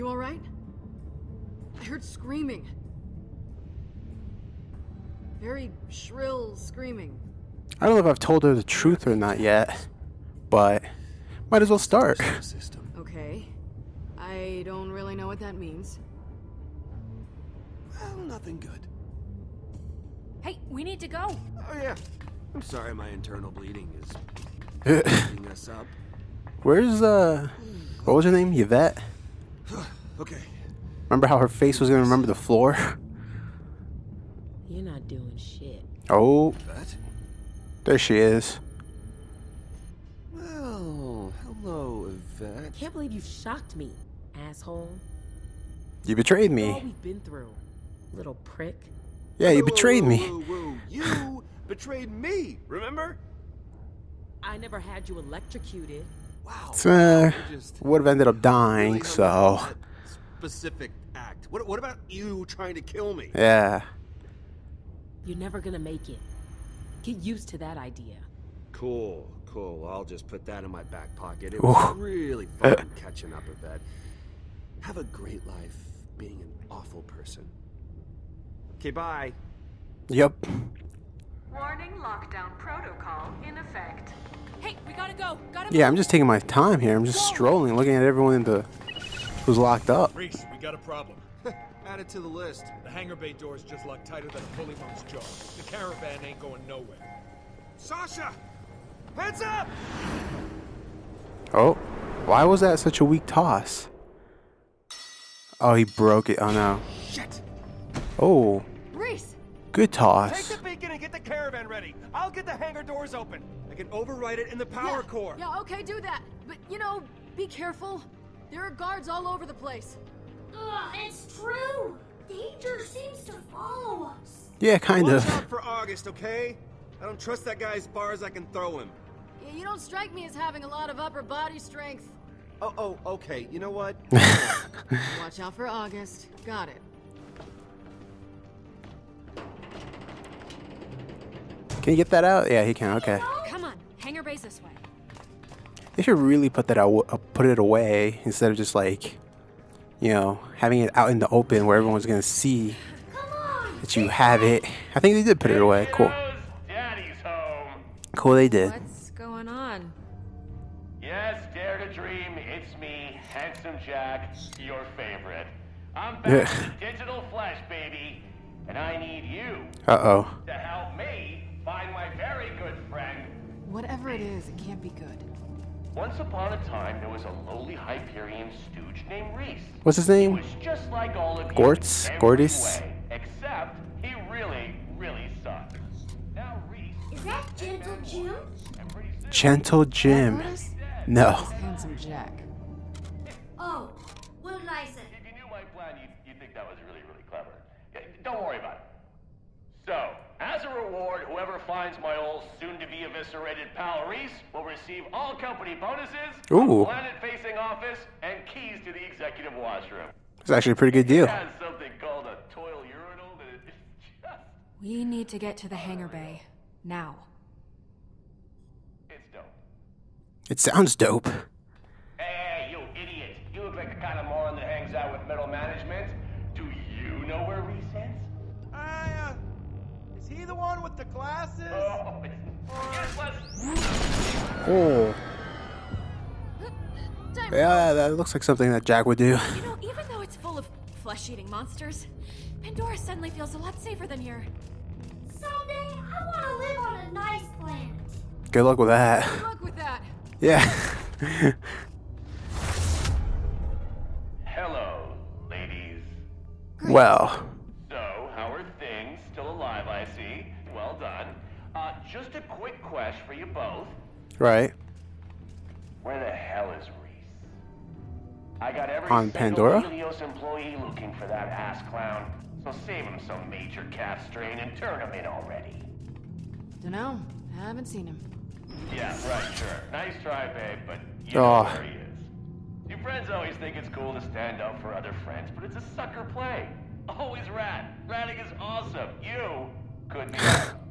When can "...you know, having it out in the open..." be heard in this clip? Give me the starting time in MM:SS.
02:29.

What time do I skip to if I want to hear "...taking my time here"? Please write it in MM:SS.
01:26.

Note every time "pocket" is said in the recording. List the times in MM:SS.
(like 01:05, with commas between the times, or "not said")
01:11.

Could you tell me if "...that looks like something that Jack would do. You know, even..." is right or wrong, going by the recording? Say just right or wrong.
right.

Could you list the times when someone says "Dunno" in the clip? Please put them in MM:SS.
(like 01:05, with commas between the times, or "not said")
04:36.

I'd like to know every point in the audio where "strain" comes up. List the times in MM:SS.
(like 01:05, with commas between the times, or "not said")
04:34.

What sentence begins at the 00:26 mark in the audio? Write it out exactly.
Where's, uh, what was her name?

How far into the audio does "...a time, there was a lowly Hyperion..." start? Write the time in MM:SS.
02:56.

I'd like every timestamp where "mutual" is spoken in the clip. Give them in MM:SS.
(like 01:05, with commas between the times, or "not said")
not said.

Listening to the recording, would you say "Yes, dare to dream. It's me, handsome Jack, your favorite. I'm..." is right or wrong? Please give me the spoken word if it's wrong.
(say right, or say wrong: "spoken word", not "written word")
right.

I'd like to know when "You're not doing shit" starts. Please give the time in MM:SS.
00:34.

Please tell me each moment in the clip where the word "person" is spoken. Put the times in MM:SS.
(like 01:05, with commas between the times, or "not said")
01:17.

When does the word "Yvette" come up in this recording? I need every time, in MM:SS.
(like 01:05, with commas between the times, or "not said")
00:28, 00:42.